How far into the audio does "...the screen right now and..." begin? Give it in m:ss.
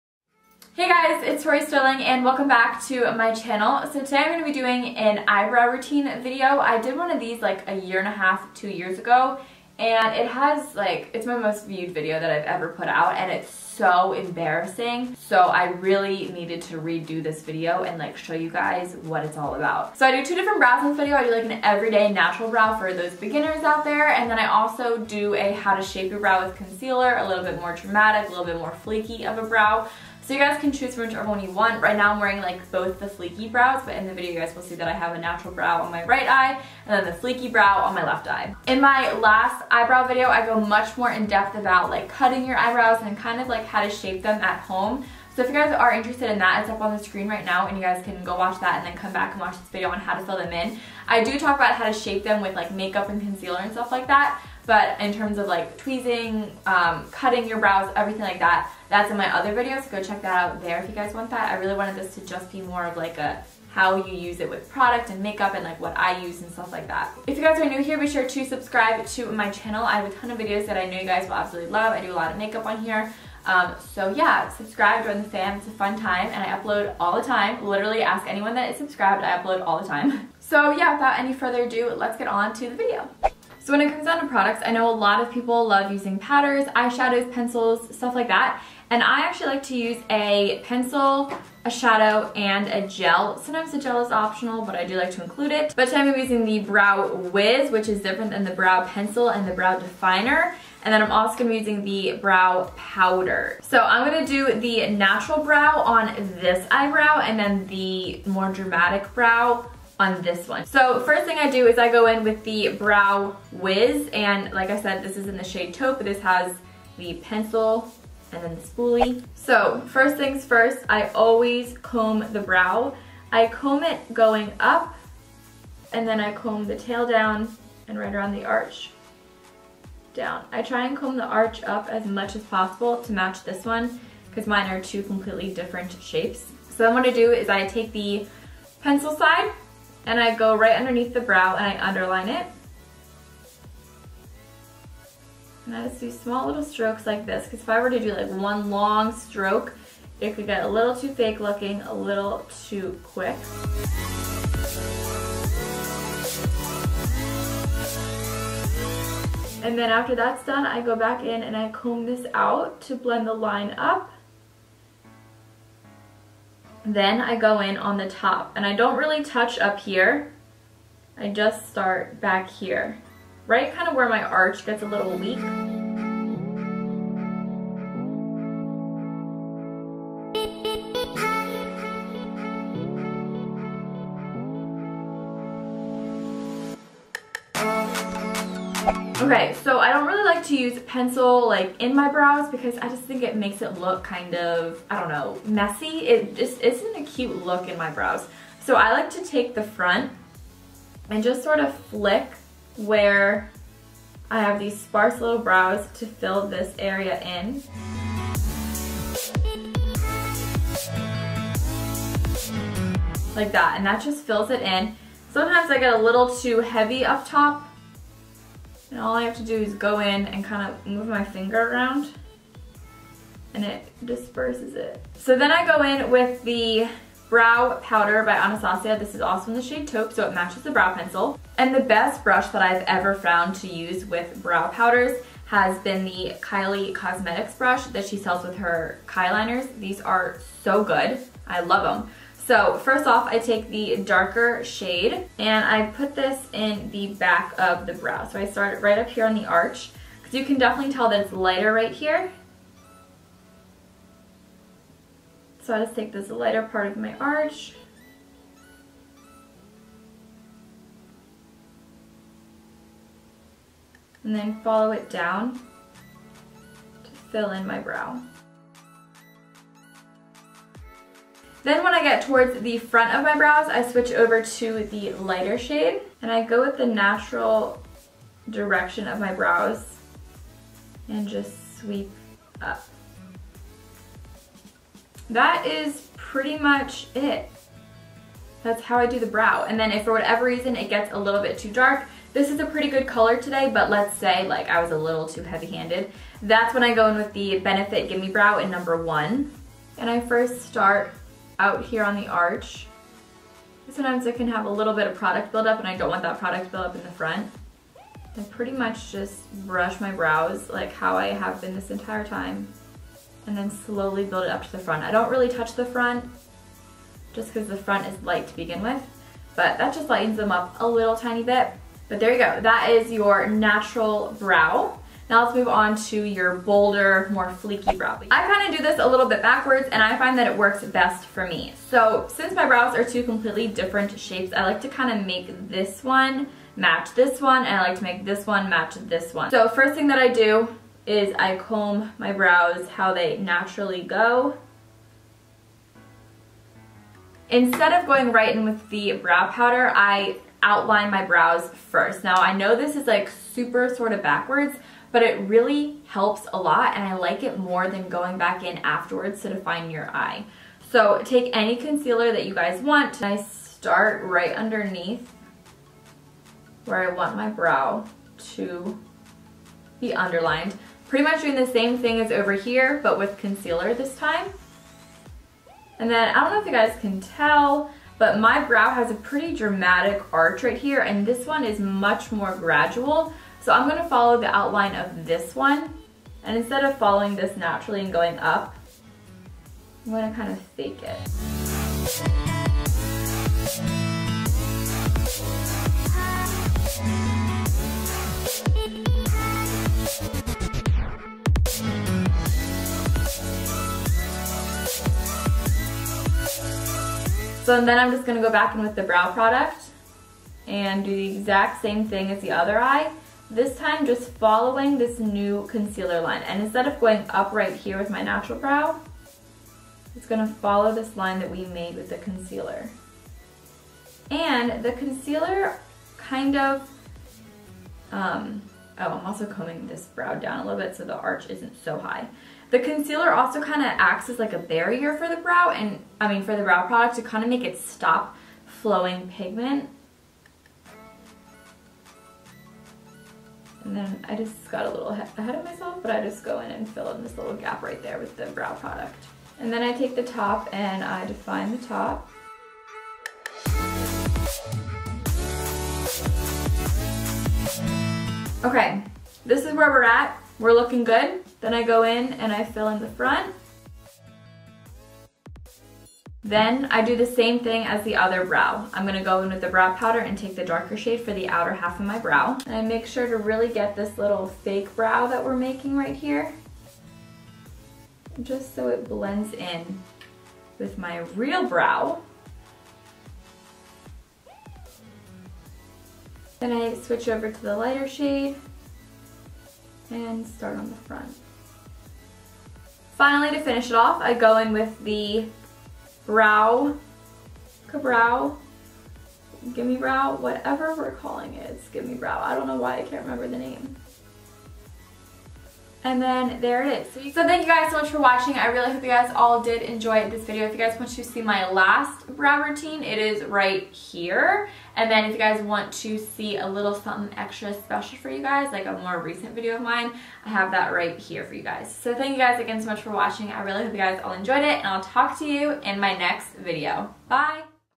0:46.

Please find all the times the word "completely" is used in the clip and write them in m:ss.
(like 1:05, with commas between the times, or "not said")
2:15, 5:33.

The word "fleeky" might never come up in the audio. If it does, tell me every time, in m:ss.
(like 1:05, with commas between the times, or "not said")
0:33, 0:37, 5:27.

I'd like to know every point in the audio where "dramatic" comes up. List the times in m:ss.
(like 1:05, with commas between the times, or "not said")
0:27, 1:48, 6:19.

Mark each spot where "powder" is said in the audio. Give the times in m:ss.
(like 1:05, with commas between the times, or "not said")
1:26, 1:42, 3:47, 3:54, 5:49, 7:49.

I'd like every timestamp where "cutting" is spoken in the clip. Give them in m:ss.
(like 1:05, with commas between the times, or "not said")
0:42, 0:57.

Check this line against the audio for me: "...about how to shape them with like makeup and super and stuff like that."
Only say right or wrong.
wrong.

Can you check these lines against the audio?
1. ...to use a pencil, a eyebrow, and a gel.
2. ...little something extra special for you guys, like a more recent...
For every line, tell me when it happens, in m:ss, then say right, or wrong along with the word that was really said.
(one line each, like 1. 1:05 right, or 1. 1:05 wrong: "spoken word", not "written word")
1. 1:29 wrong: "shadow", not "eyebrow"
2. 8:36 right.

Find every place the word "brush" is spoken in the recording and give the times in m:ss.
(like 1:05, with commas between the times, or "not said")
3:52, 3:57, 5:09.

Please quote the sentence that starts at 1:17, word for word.
Literally ask anyone that is subscribed, I upload all the time.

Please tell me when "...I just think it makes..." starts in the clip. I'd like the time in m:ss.
3:12.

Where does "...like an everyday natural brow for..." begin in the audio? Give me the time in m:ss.
0:21.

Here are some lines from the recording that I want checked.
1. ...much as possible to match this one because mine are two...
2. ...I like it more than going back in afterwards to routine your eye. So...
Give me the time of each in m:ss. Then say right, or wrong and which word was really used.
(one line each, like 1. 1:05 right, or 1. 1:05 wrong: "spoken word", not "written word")
1. 2:12 right
2. 5:57 wrong: "define", not "routine".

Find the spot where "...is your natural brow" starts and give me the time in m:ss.
5:22.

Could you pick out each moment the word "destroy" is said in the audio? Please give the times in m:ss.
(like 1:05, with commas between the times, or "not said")
not said.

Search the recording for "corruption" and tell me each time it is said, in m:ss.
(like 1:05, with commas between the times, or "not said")
not said.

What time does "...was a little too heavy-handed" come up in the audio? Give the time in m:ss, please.
4:54.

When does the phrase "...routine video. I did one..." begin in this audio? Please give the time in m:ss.
0:05.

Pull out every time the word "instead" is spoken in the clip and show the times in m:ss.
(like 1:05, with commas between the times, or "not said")
5:47, 6:26, 6:56.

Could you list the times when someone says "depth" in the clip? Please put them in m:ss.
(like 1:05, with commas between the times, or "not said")
0:41.